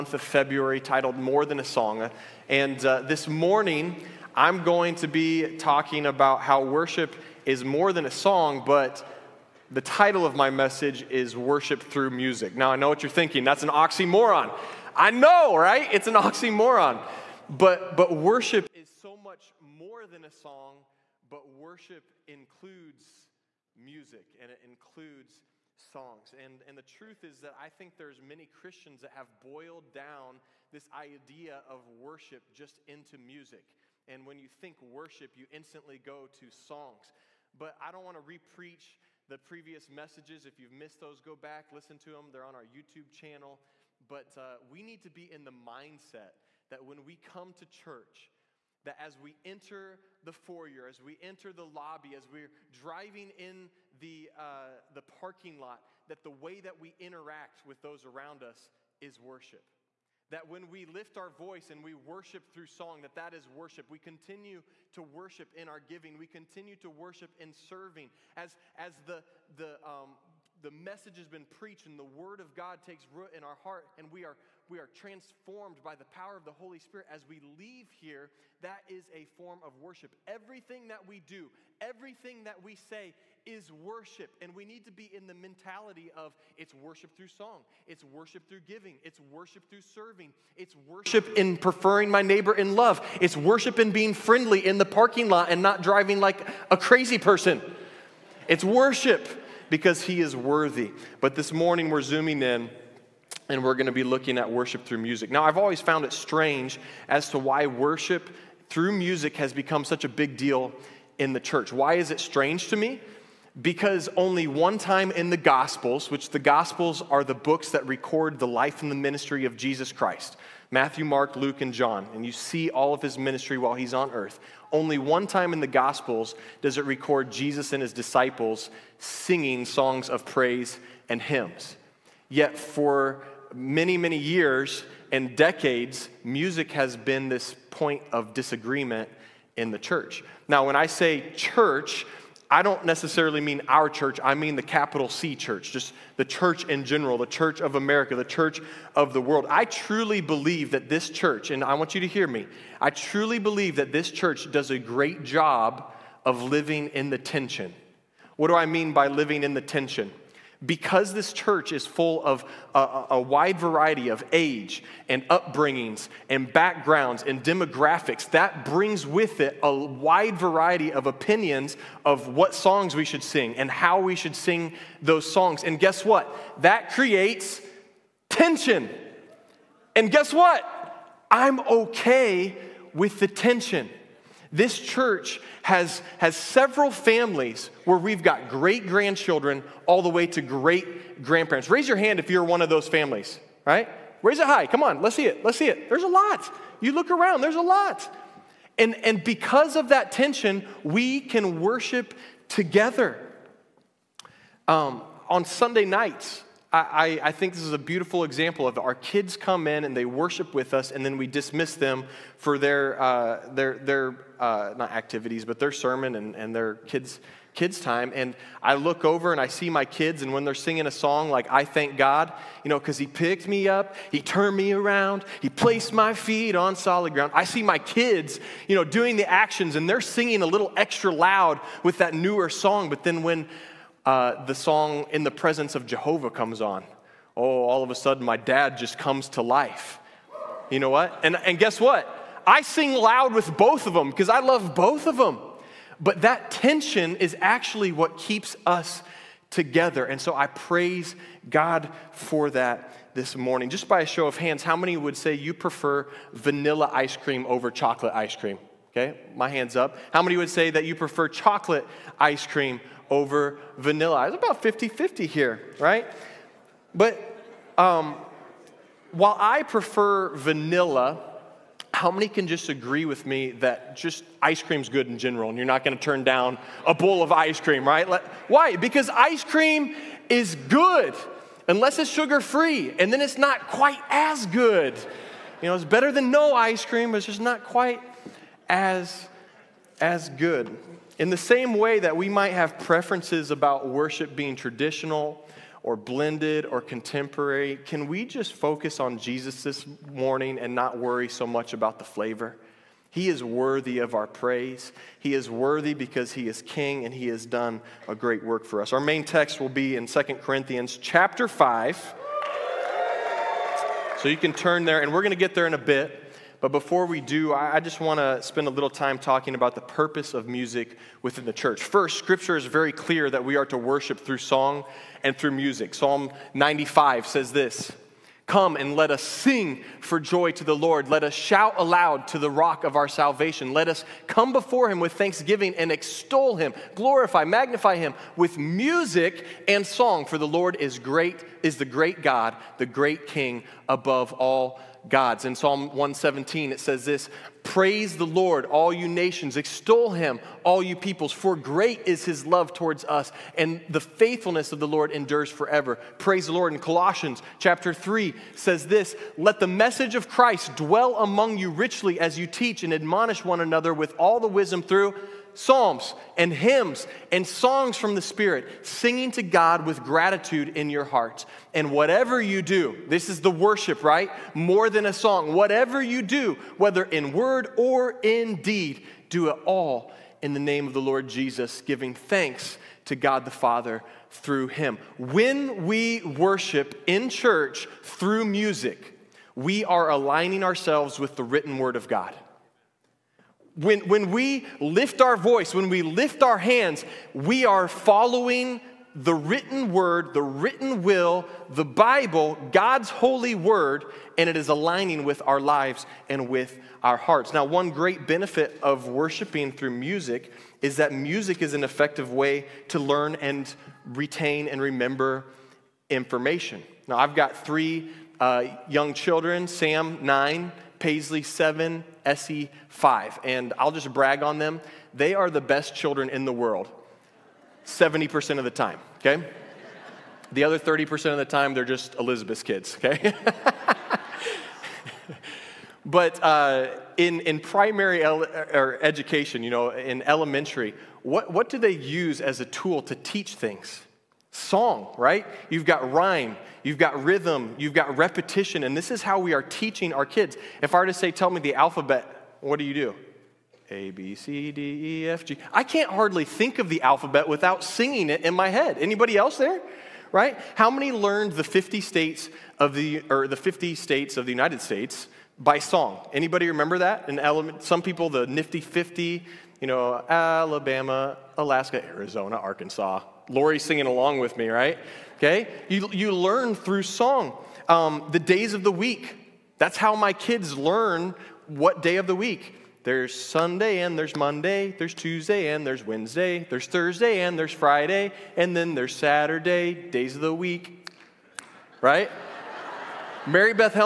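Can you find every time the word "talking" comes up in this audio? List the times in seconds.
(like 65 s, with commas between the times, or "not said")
5 s, 319 s.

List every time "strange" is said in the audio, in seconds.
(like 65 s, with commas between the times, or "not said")
106 s, 112 s.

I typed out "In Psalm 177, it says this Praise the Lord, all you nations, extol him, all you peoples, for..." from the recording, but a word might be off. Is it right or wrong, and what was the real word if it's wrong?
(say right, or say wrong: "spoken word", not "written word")
wrong: "117", not "177".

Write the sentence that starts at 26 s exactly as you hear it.
And, and the truth is that I think there's many Christians that have boiled down this idea of worship just into music.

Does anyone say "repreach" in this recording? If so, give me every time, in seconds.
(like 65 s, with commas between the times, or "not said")
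38 s.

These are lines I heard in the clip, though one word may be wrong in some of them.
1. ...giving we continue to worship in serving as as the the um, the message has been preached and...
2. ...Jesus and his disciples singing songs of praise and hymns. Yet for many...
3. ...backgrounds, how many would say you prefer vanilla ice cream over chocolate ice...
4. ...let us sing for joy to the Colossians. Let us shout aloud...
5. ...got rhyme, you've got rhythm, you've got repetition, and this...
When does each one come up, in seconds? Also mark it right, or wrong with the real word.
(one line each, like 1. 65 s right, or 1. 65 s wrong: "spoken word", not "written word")
1. 65 s right
2. 127 s right
3. 254 s wrong: "hands", not "backgrounds"
4. 328 s wrong: "Lord", not "Colossians"
5. 445 s right.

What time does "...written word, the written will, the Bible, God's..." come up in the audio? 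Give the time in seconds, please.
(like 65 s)
399 s.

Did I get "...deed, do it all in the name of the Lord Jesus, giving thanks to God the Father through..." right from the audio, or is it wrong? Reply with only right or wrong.
right.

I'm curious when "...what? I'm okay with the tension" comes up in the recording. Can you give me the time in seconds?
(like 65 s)
180 s.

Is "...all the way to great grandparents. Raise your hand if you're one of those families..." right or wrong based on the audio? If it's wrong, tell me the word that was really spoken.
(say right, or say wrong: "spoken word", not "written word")
right.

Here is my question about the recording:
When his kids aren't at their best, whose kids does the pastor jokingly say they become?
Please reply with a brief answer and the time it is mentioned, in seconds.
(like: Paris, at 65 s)
Elizabeth's, at 432 s.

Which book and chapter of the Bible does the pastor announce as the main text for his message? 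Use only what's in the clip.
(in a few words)
2 Corinthians 5.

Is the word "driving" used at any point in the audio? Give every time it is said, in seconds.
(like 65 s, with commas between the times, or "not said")
52 s, 95 s.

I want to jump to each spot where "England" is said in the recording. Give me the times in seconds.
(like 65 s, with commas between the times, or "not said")
not said.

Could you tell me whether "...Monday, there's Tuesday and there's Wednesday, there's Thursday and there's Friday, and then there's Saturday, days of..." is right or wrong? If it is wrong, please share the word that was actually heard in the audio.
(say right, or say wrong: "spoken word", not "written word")
right.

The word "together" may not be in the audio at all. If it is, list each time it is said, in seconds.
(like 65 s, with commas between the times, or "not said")
202 s, 249 s.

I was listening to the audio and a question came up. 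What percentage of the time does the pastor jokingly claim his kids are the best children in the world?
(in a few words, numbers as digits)
70%.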